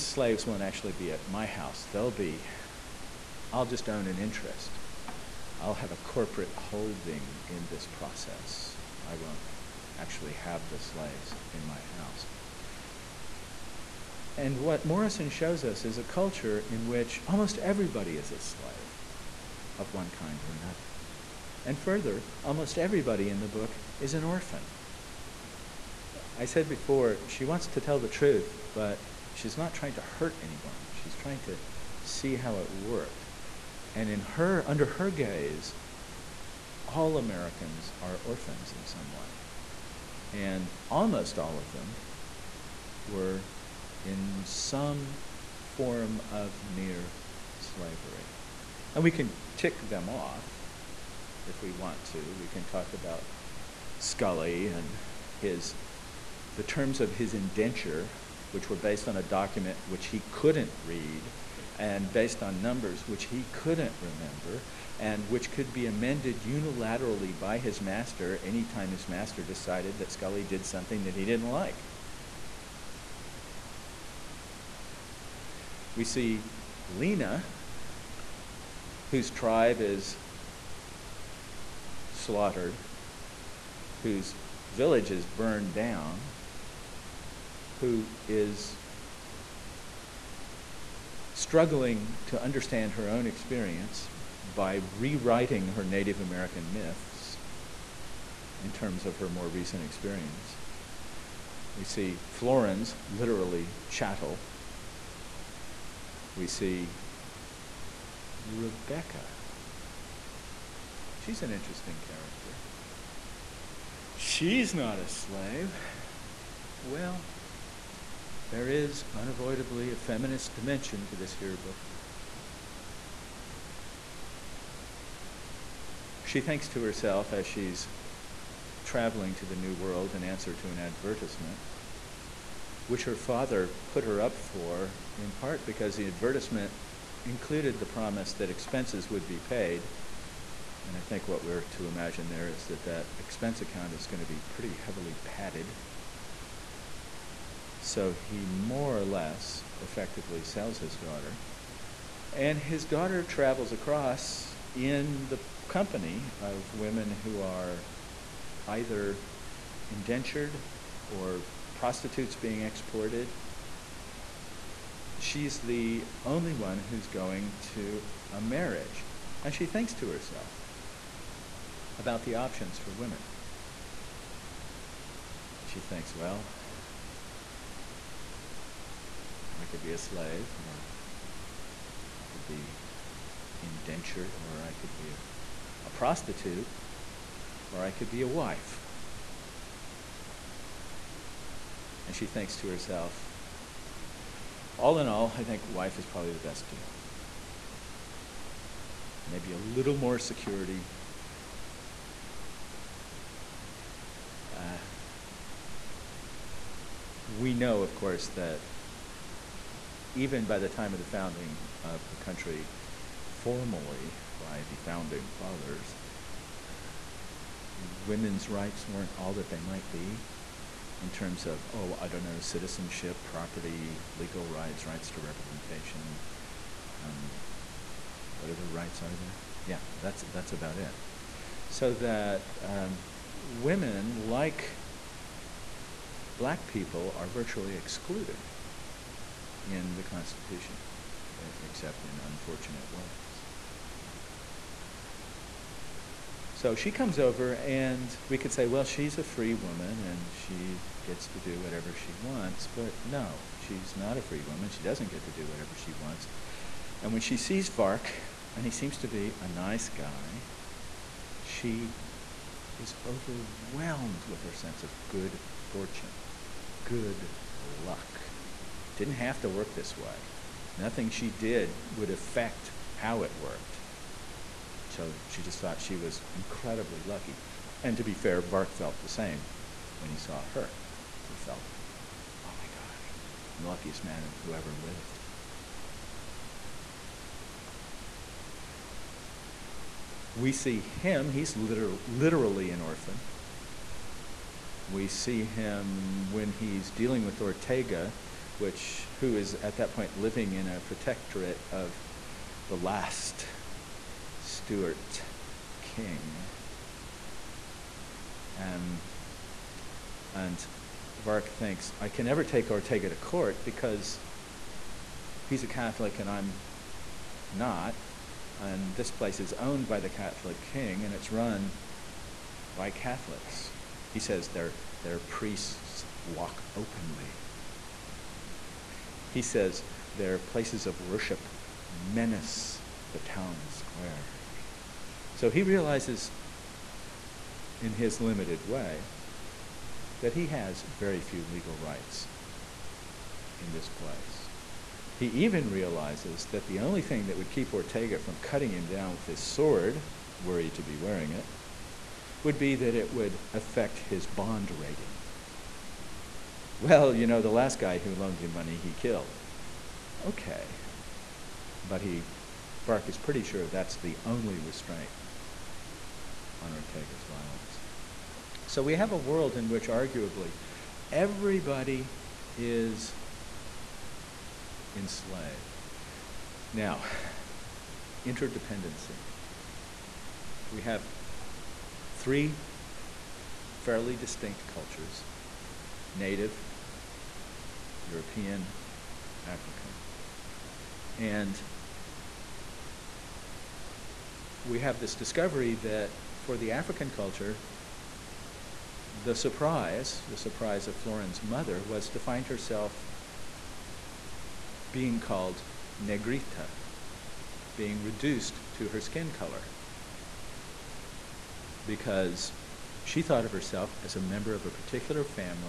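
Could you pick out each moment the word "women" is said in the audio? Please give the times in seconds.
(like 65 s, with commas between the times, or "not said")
156 s, 172 s, 218 s, 233 s.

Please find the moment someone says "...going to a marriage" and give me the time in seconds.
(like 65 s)
167 s.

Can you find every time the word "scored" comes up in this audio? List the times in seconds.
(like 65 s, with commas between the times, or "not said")
not said.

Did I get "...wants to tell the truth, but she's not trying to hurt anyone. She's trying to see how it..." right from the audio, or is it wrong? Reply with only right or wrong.
right.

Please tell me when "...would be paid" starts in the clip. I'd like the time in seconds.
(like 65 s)
139 s.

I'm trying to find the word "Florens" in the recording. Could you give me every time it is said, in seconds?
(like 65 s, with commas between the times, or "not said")
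102 s, 400 s.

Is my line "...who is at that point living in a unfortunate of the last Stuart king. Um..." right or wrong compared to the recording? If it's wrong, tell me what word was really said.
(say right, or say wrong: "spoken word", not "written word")
wrong: "protectorate", not "unfortunate".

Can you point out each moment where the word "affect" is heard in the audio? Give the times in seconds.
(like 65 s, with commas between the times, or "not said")
272 s, 353 s.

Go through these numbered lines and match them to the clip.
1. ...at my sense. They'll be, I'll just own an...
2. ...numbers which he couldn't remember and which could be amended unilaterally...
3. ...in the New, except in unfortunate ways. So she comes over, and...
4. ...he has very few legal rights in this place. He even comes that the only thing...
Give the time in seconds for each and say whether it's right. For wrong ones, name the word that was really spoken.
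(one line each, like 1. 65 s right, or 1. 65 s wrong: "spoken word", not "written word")
1. 1 s wrong: "house", not "sense"
2. 62 s right
3. 239 s wrong: "Constitution", not "New"
4. 340 s wrong: "realizes", not "comes".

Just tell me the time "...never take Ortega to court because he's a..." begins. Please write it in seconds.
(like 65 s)
312 s.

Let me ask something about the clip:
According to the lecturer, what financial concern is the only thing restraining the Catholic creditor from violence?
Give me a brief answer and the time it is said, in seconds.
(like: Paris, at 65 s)
His bond rating, at 353 s.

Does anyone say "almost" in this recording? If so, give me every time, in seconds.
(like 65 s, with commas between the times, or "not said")
17 s, 22 s, 40 s.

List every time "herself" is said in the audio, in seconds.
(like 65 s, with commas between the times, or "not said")
126 s, 170 s, 192 s, 402 s, 413 s.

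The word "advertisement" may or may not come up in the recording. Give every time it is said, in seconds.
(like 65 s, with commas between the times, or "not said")
130 s, 136 s.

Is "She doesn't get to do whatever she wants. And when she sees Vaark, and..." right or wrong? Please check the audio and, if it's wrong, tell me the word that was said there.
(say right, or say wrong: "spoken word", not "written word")
right.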